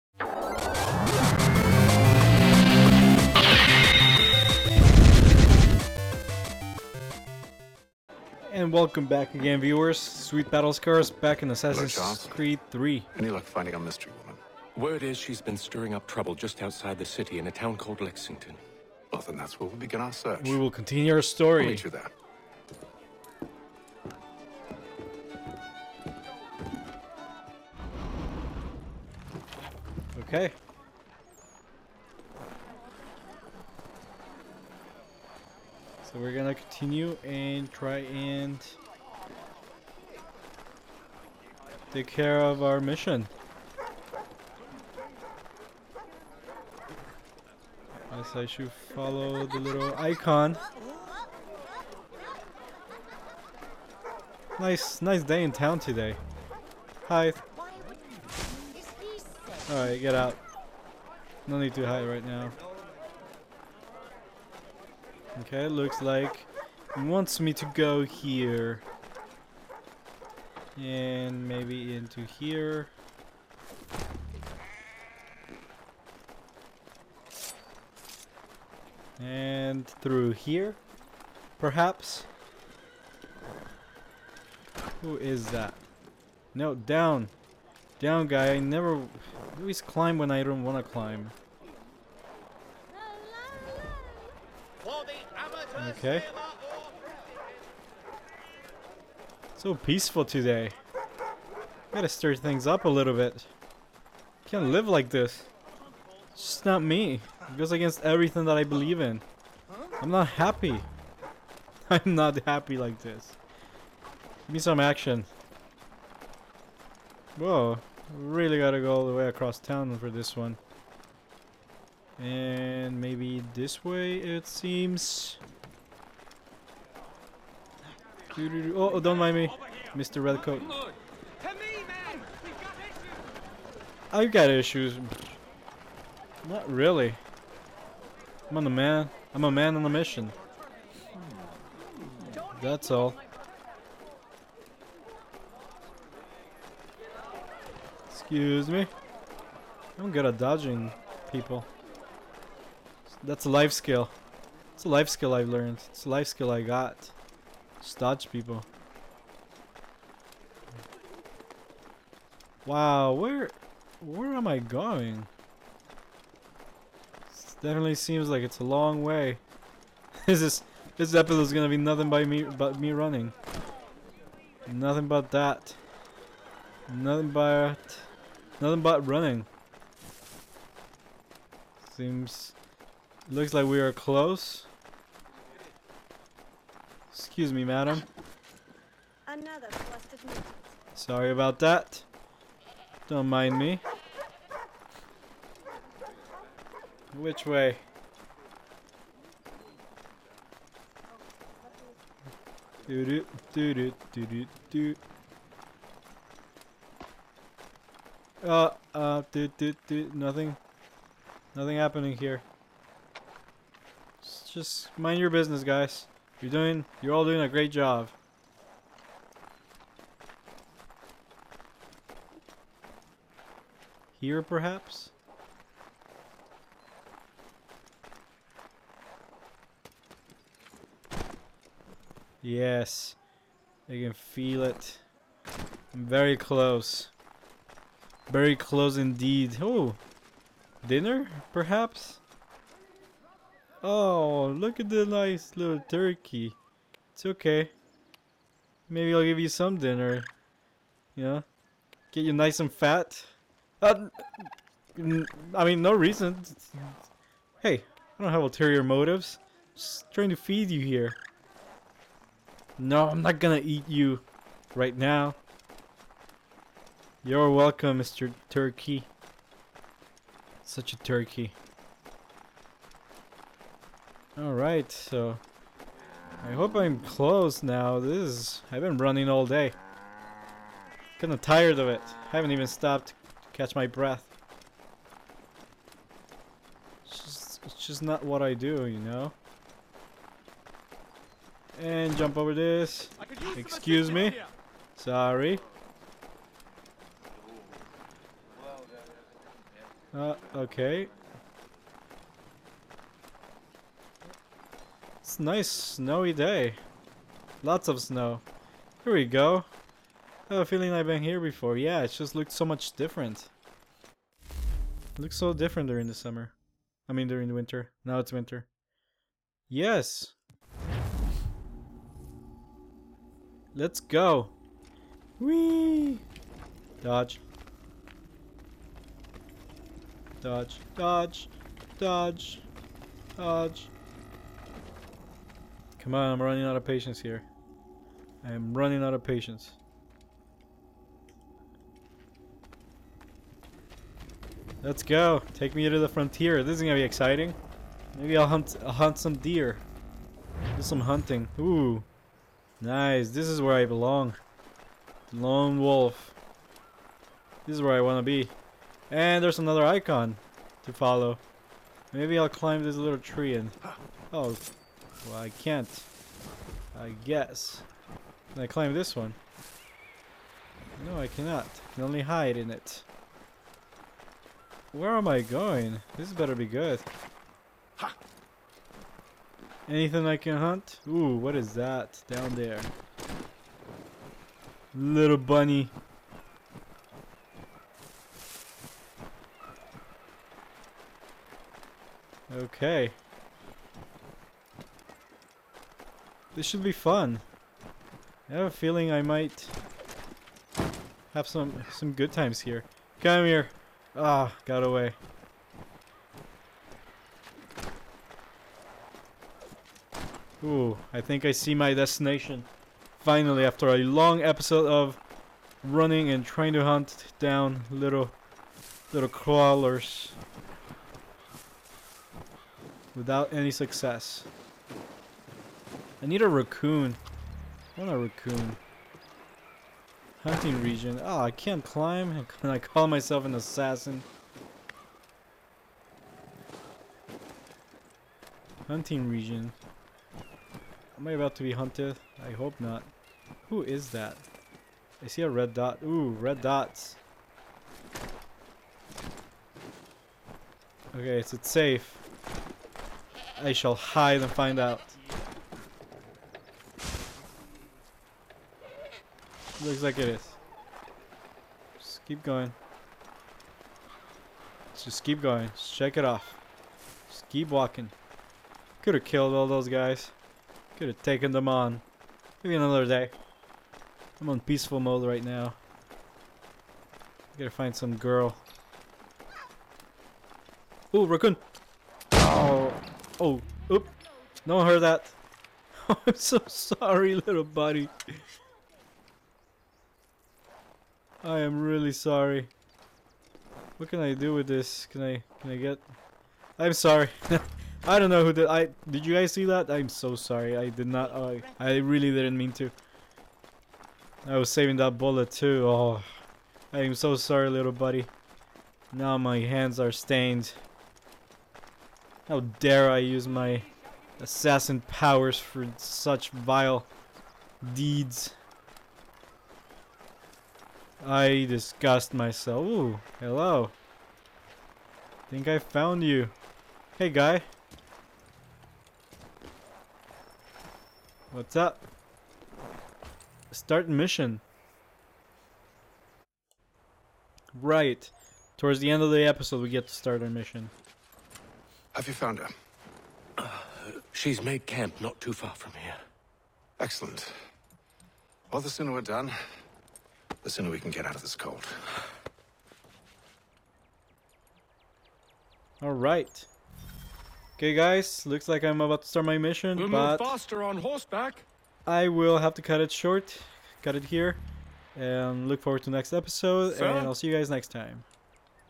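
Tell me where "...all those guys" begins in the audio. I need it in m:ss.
7:49.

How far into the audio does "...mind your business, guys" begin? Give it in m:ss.
3:34.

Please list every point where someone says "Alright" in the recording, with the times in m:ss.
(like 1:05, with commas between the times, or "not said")
0:59, 4:34.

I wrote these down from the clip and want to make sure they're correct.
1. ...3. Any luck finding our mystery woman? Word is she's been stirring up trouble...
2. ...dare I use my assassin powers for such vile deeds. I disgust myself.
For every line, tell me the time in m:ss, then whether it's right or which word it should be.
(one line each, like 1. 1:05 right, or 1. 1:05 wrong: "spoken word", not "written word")
1. 0:12 right
2. 8:32 right.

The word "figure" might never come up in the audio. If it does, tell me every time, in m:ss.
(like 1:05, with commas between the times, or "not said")
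not said.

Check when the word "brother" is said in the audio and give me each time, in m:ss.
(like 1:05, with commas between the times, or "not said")
not said.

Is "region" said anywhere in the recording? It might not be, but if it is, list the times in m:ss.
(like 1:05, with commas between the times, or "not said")
7:10, 7:19.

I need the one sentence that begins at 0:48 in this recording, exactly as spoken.
As I should follow the little icon.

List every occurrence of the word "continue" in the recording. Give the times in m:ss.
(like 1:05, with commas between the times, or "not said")
0:20, 0:36.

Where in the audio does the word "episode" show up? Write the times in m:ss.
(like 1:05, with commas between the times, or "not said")
2:51, 6:54, 8:59, 9:26.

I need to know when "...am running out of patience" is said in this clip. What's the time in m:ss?
5:38.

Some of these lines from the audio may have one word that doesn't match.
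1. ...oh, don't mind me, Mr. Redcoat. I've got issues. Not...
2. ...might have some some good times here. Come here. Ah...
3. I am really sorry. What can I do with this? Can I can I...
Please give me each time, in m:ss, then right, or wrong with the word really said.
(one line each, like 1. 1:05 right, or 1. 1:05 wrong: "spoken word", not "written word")
1. 2:08 right
2. 6:39 right
3. 8:11 right.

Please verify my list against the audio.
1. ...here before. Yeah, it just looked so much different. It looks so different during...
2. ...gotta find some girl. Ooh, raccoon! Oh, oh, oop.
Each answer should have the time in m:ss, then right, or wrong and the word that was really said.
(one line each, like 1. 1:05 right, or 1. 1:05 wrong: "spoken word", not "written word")
1. 5:11 right
2. 7:57 right.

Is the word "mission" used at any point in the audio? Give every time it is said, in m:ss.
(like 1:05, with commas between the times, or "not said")
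0:42, 2:19, 8:54, 9:00, 9:19.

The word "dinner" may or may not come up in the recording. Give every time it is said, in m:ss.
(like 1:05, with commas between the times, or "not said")
4:00, 4:09.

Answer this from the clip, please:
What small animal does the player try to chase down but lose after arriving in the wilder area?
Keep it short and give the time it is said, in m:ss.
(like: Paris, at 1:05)
Bunny, at 6:24.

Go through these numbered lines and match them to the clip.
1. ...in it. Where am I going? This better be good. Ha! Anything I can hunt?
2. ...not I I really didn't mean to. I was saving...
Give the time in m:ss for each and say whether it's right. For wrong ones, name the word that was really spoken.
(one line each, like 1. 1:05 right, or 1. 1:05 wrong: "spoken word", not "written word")
1. 6:12 right
2. 8:21 right.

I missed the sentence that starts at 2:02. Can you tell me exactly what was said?
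And maybe this way it seems.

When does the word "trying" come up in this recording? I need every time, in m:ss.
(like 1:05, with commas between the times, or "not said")
4:20, 6:56.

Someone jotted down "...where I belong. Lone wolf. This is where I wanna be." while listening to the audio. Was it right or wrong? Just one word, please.
right.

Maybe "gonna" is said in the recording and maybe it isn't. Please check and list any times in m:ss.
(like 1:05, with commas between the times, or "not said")
0:36, 2:51, 4:23, 5:46.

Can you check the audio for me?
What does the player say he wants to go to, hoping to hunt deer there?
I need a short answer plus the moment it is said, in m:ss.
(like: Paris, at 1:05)
The frontier, at 5:45.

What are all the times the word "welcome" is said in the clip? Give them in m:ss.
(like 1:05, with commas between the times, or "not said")
0:08, 4:27.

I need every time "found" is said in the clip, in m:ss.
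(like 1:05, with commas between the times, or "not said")
8:45, 9:02.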